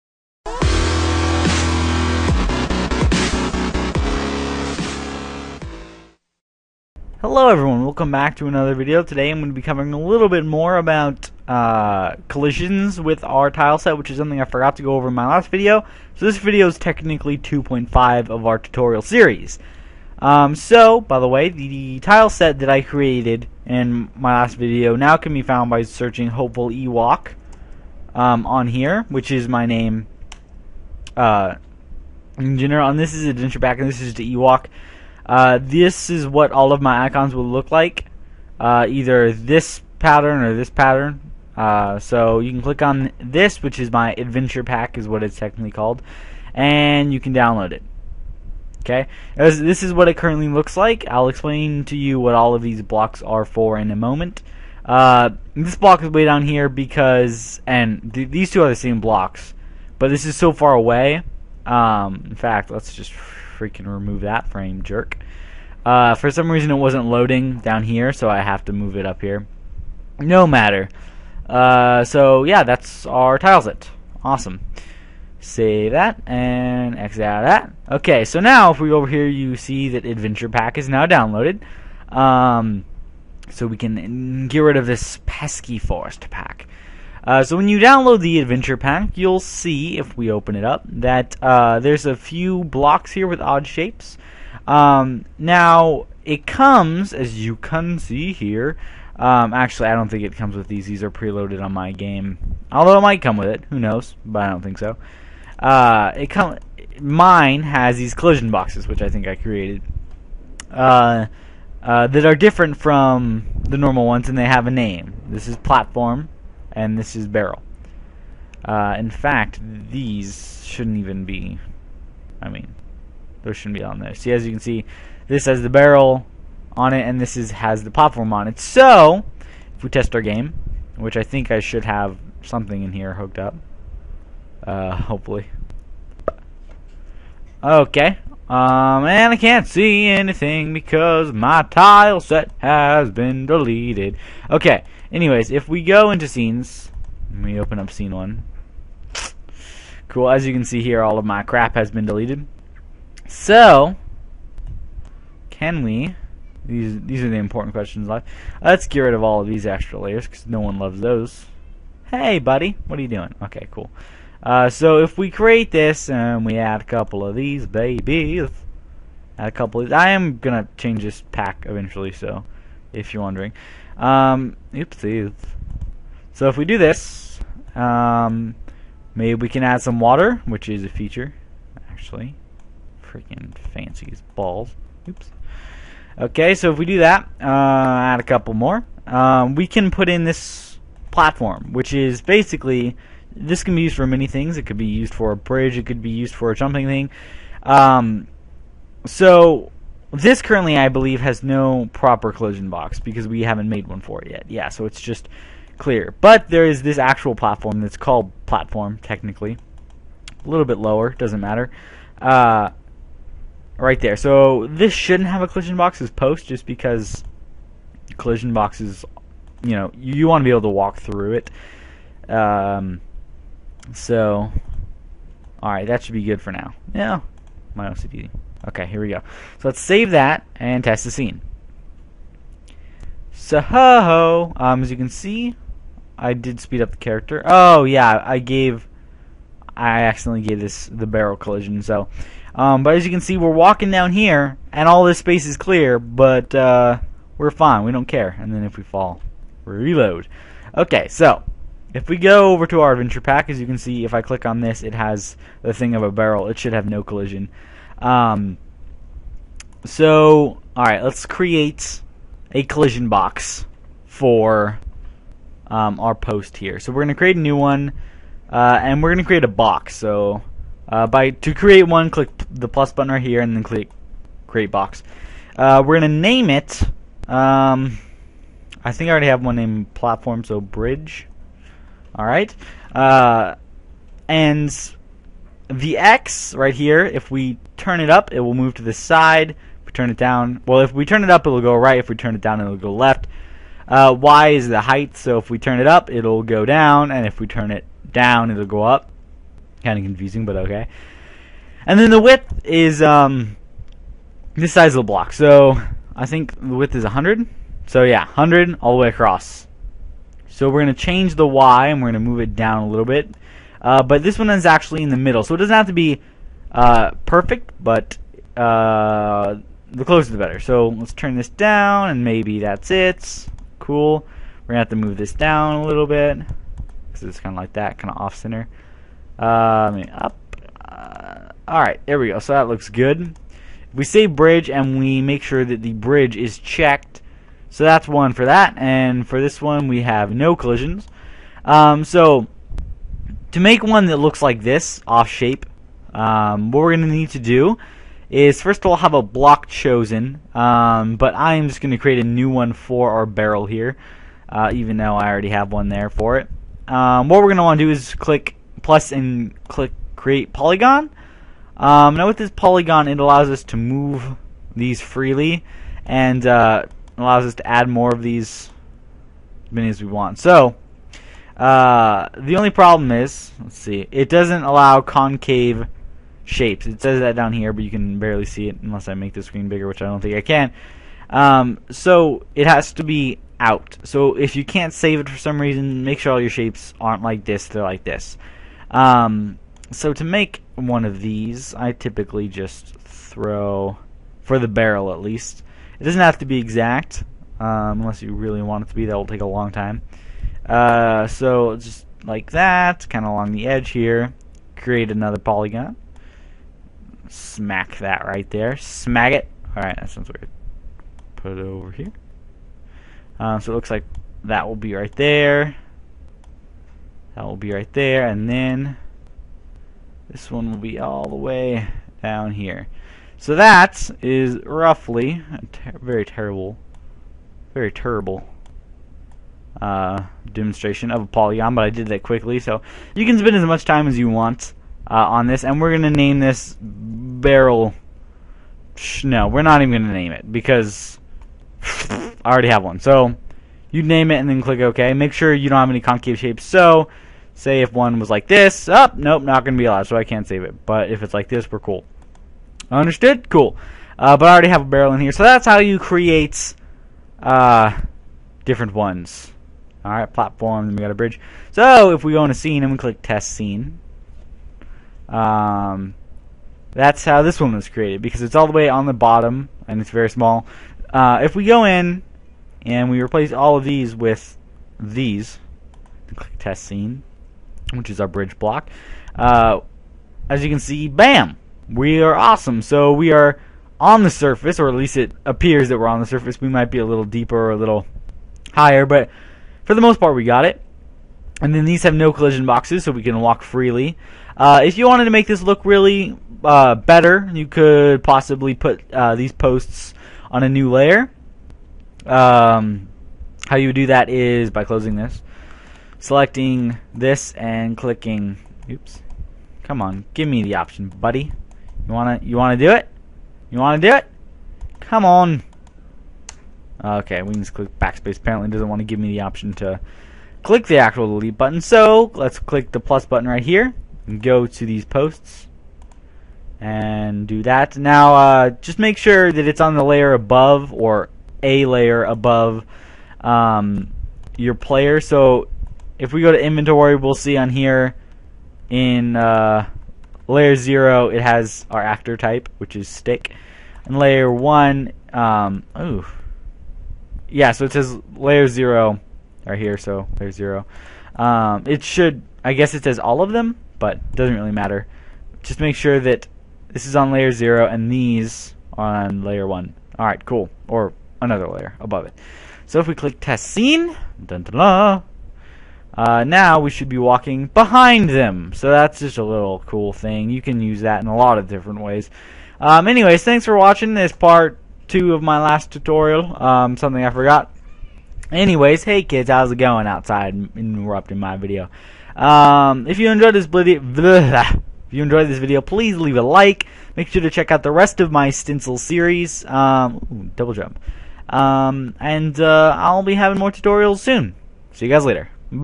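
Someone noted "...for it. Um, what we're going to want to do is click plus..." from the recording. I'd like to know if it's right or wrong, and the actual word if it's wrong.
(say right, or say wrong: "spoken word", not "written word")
right.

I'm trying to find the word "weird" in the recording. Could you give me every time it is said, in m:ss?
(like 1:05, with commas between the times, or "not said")
6:50.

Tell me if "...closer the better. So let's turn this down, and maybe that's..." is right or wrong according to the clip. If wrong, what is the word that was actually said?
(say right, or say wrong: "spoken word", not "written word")
right.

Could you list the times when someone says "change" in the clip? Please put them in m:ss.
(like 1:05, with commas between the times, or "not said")
2:50, 5:11.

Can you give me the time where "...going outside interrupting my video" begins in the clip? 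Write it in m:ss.
9:39.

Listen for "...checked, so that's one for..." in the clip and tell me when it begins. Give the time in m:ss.
5:36.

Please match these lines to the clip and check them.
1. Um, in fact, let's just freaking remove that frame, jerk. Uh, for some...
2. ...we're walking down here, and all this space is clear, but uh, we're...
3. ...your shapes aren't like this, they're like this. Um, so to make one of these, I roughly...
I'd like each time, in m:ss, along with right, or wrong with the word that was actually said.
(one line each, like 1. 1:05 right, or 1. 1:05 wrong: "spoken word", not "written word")
1. 1:01 right
2. 4:03 right
3. 6:26 wrong: "typically", not "roughly".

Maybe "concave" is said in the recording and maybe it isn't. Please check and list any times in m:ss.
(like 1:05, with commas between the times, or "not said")
6:15, 7:25.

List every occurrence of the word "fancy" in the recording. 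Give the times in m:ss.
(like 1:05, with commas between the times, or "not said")
3:03.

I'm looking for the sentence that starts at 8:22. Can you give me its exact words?
Um, how you would do that is by closing this, selecting this, and clicking.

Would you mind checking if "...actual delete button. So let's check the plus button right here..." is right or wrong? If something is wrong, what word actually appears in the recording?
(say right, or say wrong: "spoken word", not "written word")
wrong: "click", not "check".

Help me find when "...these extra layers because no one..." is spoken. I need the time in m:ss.
2:39.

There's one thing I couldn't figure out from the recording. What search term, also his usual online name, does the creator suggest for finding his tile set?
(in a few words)
Hopeful Ewok.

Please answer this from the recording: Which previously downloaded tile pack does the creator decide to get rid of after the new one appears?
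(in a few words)
forest pack.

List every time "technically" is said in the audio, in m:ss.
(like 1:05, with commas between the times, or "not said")
0:16, 0:45, 3:29.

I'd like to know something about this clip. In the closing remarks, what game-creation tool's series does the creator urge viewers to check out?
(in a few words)
Stencyl.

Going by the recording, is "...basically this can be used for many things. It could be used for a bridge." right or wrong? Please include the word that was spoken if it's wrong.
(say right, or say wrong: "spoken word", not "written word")
right.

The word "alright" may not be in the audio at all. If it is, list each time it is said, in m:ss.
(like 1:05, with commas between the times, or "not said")
3:45, 4:20, 5:31, 7:40, 9:20.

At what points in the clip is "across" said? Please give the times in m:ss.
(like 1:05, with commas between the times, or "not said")
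5:09.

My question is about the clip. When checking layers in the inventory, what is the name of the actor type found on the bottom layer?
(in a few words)
stick.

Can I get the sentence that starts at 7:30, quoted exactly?
But if it's like this, we're cool.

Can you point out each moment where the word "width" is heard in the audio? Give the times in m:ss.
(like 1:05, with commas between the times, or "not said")
5:02, 5:06.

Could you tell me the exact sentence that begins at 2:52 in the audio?
So if you're wondering, um, oopsies.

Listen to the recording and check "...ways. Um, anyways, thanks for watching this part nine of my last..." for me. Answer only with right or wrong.
wrong.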